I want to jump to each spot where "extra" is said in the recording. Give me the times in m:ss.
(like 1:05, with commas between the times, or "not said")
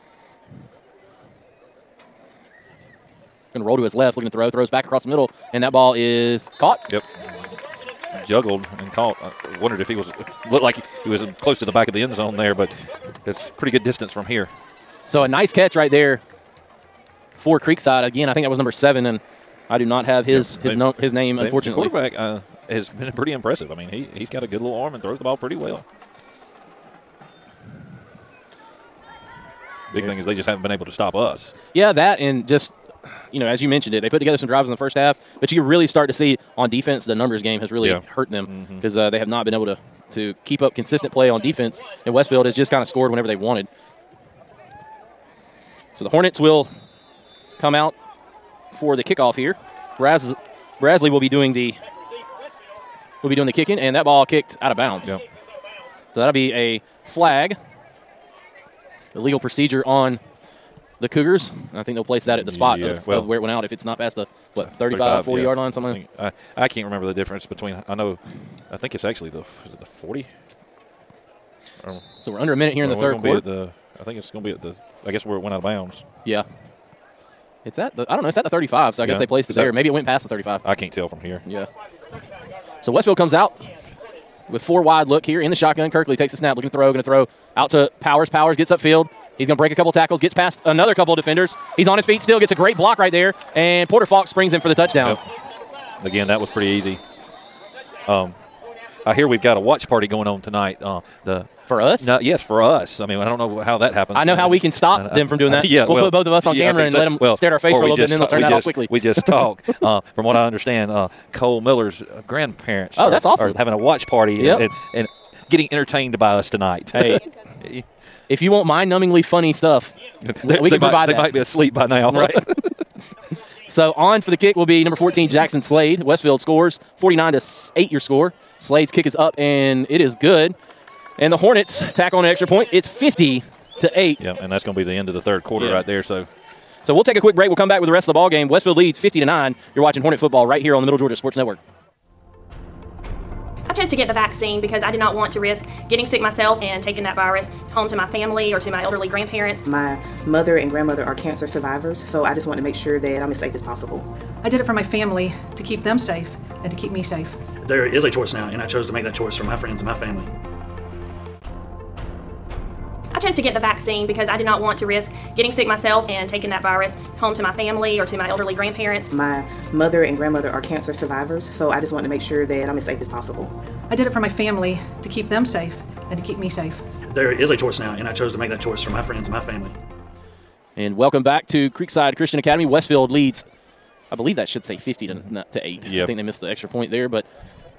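2:12, 3:06.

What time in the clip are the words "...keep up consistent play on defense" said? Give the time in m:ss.
0:40.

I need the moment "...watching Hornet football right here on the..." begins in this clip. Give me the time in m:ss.
2:19.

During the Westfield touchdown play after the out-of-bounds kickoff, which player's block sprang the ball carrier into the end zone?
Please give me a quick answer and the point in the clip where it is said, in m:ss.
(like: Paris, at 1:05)
Porter Falk, at 1:33.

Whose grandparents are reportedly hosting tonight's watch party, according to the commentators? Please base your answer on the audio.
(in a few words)
Cole Miller.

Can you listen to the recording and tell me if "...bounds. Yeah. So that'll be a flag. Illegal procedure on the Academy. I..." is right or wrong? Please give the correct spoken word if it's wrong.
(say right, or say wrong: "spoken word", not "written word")
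wrong: "Cougars", not "Academy".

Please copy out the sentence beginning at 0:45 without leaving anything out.
So the Hornets will come out for the kickoff here.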